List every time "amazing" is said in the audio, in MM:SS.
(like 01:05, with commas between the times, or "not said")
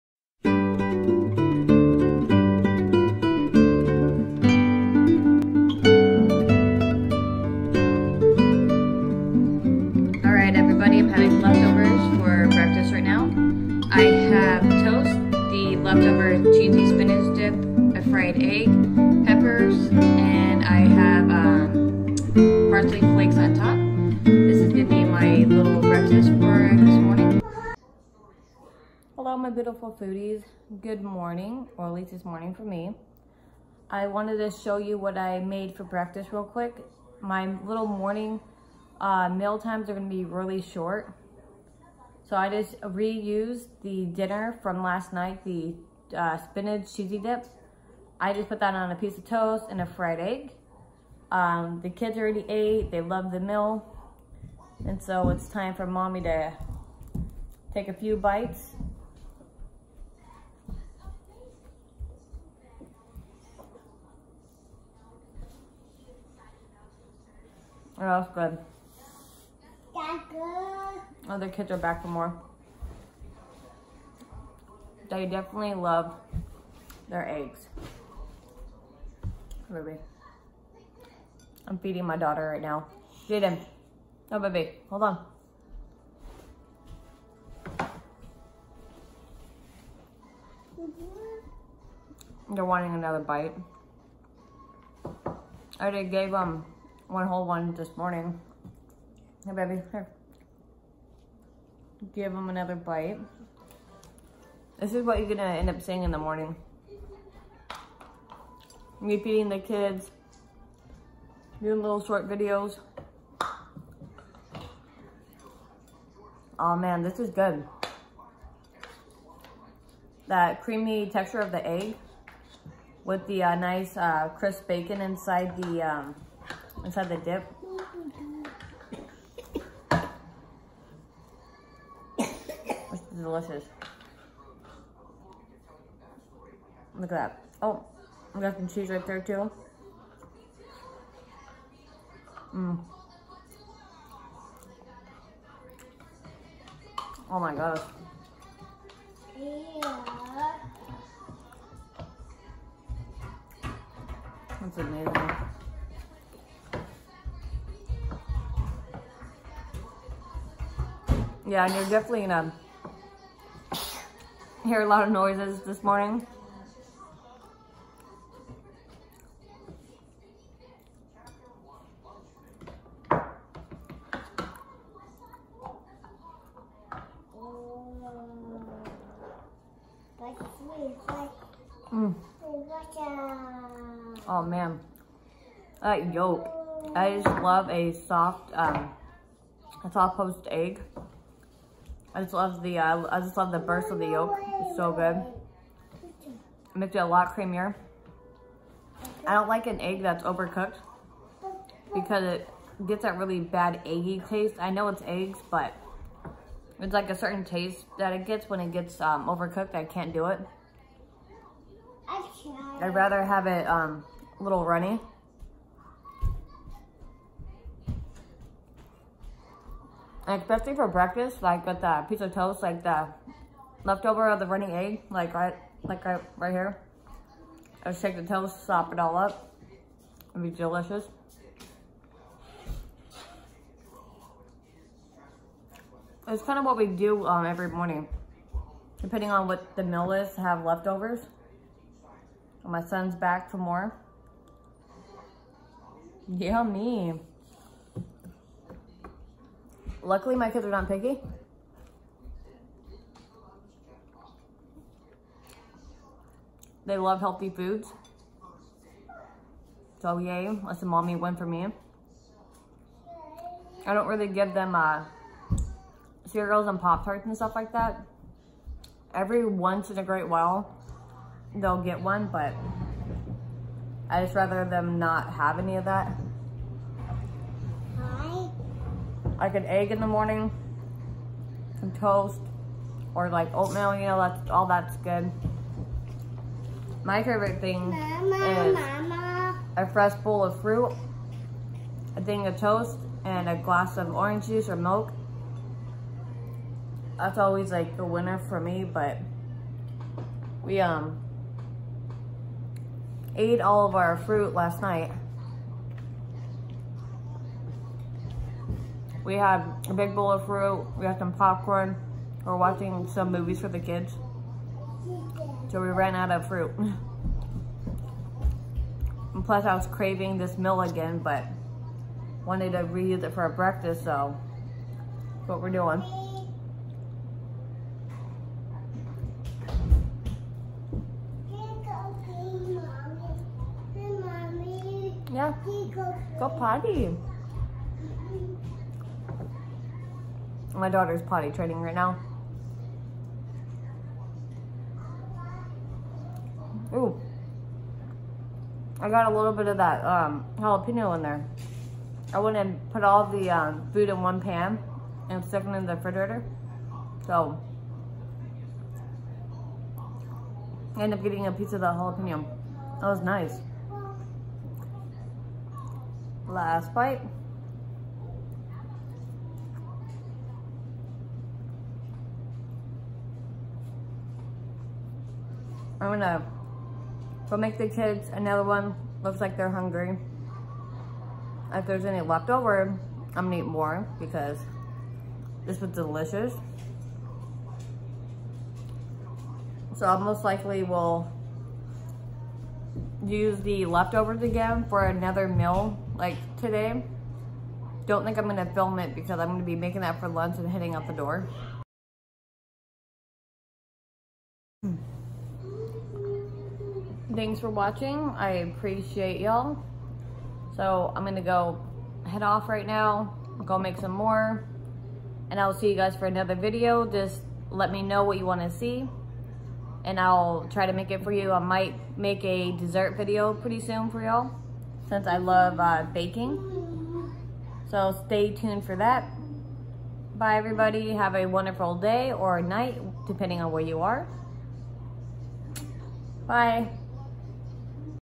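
02:34.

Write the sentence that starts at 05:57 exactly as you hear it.
So, I ended up getting a piece of the jalapeno.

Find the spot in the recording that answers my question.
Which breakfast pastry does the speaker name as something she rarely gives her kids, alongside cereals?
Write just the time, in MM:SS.
04:26.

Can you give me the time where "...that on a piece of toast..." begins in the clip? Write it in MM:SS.
00:48.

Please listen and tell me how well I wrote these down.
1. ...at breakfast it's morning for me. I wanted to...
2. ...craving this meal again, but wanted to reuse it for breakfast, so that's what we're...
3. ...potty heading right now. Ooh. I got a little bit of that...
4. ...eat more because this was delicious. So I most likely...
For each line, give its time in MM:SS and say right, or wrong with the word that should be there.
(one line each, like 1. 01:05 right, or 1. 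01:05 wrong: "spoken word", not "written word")
1. 00:31 wrong: "least", not "breakfast"
2. 05:19 right
3. 05:41 wrong: "training", not "heading"
4. 06:23 right.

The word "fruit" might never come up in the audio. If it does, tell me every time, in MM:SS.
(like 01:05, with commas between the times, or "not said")
04:50, 05:04, 05:10, 05:16.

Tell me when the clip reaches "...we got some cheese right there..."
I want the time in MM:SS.
02:18.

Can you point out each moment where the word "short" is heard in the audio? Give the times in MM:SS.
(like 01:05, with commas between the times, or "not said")
00:40, 01:52.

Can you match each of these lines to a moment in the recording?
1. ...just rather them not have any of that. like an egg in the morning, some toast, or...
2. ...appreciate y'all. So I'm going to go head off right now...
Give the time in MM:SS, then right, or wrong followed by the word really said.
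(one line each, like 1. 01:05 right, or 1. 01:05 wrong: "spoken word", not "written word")
1. 04:34 right
2. 06:48 right.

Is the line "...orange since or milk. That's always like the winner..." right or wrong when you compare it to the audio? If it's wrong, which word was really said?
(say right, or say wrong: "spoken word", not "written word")
wrong: "juice", not "since".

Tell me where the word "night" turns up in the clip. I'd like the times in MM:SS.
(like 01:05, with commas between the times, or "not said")
00:45, 05:04, 07:12.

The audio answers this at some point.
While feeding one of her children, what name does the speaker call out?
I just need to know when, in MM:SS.
01:19.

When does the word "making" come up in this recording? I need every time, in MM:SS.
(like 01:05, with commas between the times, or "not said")
06:39.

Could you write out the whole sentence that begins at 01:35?
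I already gave them one whole one this morning.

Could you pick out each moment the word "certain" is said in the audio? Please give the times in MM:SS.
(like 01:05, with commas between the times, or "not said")
03:27.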